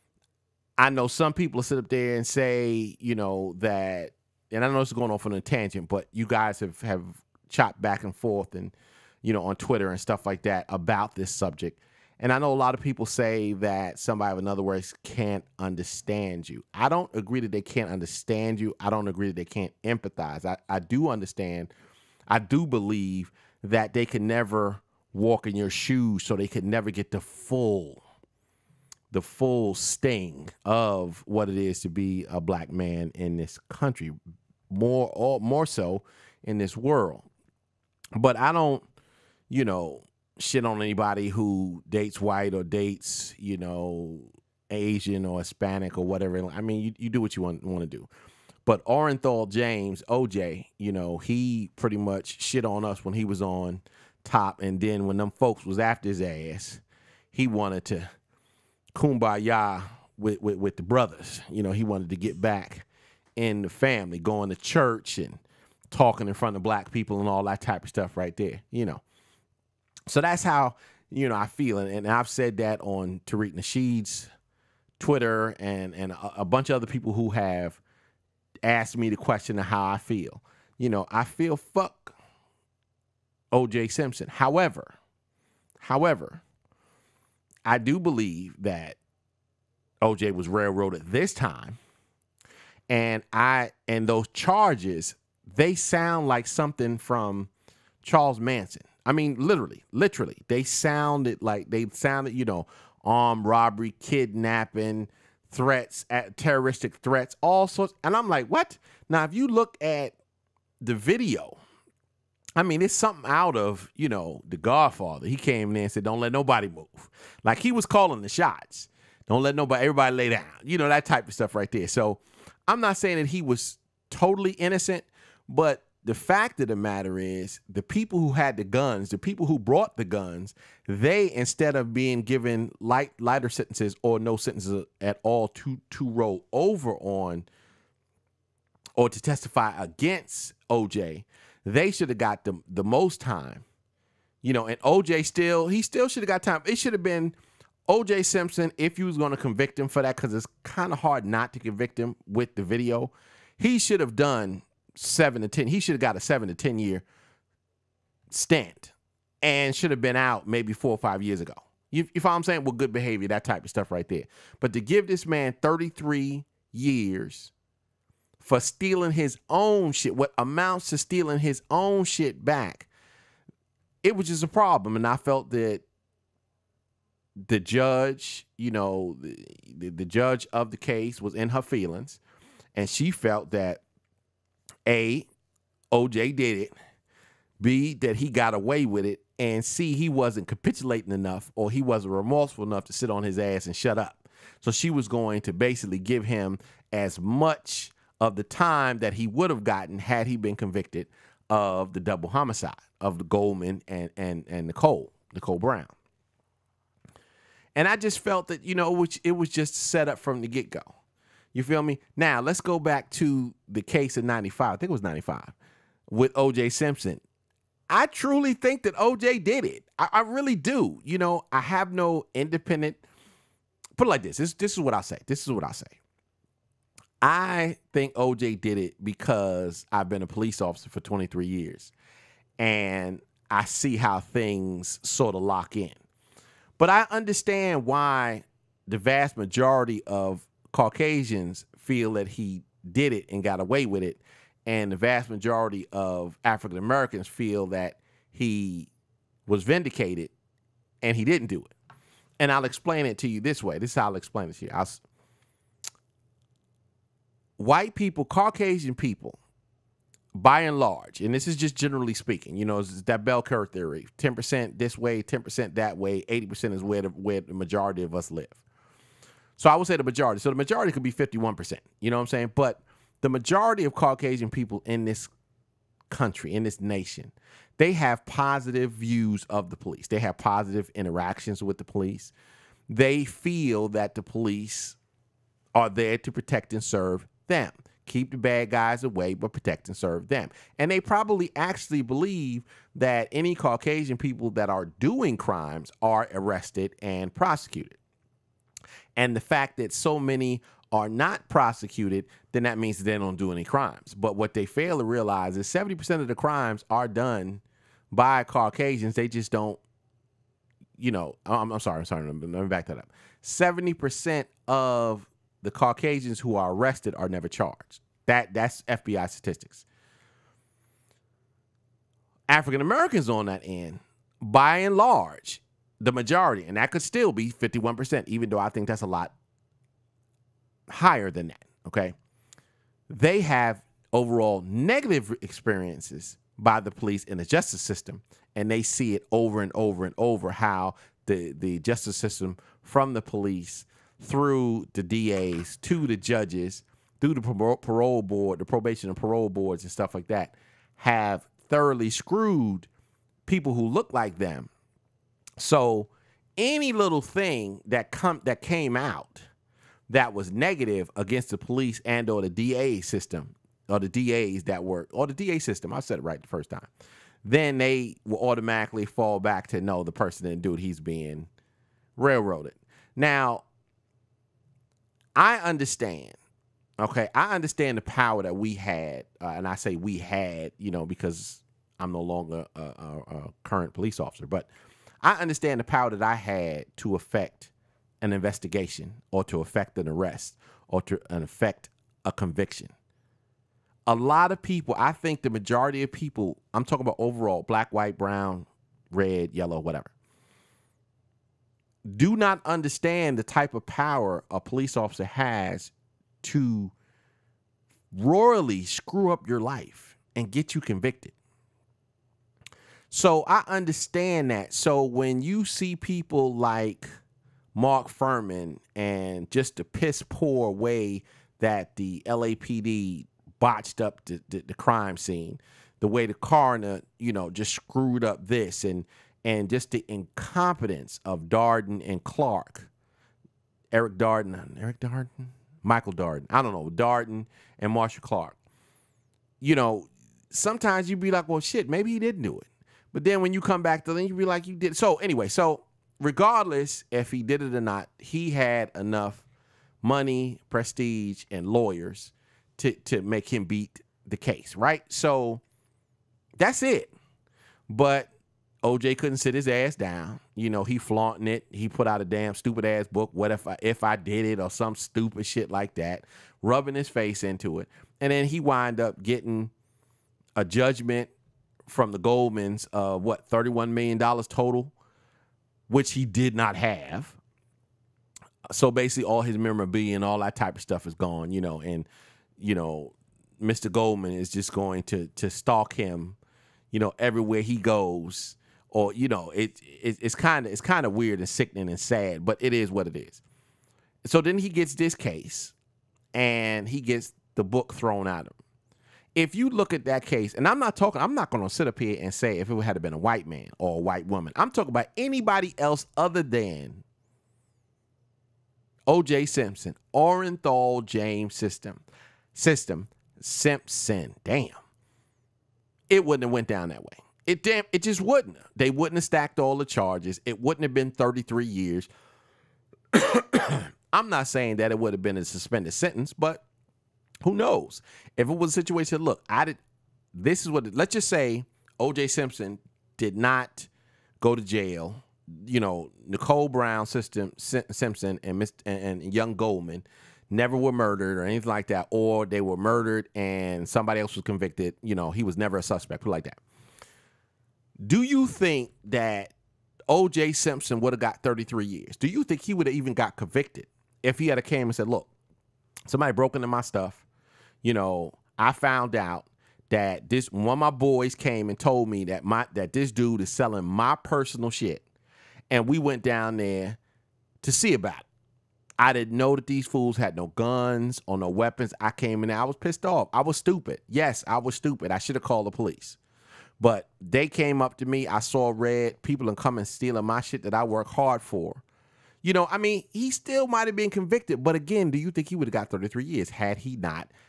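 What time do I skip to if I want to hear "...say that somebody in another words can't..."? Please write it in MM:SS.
00:13.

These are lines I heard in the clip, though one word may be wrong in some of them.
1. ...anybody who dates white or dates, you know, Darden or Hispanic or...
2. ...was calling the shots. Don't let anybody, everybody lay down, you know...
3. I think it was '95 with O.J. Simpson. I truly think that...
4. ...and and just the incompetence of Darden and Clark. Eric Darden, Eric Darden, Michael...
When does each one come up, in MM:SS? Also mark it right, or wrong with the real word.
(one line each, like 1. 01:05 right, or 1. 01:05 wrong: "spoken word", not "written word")
1. 00:40 wrong: "Asian", not "Darden"
2. 01:57 wrong: "nobody", not "anybody"
3. 03:34 right
4. 07:08 right.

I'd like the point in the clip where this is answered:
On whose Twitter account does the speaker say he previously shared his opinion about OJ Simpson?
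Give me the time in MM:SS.
01:13.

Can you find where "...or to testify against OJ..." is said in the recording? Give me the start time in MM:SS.
02:18.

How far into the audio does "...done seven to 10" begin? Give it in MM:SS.
02:34.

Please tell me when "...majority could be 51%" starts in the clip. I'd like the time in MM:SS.
04:30.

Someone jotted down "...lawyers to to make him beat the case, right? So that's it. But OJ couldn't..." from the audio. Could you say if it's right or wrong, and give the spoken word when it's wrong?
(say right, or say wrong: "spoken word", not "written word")
right.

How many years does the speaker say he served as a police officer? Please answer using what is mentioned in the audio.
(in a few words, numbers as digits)
23.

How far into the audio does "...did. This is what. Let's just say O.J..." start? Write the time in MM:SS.
08:49.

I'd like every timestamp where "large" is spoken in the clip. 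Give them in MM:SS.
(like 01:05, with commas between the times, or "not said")
04:20, 05:24.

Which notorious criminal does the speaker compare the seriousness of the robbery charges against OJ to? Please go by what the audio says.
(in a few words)
Charles Manson.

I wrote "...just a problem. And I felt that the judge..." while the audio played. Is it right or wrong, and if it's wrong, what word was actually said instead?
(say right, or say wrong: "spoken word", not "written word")
right.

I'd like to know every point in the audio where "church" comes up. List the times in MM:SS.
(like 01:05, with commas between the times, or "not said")
01:04.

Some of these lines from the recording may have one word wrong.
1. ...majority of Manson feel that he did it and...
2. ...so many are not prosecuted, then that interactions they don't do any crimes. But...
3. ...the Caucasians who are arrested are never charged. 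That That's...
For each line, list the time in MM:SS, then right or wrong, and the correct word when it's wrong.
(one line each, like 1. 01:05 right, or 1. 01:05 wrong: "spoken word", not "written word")
1. 03:59 wrong: "Caucasians", not "Manson"
2. 04:59 wrong: "means", not "interactions"
3. 05:15 right.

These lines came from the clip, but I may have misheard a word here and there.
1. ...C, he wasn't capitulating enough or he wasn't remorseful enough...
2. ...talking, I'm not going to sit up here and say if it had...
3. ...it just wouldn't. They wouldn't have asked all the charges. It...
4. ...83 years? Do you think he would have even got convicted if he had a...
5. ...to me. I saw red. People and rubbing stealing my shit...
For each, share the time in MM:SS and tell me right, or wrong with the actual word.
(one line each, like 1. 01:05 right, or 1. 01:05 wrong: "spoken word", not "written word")
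1. 03:09 right
2. 08:20 right
3. 08:37 wrong: "stacked", not "asked"
4. 09:11 wrong: "33", not "83"
5. 09:37 wrong: "coming", not "rubbing".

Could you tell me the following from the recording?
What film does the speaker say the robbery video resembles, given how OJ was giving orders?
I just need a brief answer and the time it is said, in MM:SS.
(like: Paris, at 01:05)
The Godfather, at 01:54.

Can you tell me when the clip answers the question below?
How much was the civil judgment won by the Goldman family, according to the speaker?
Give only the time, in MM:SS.
07:53.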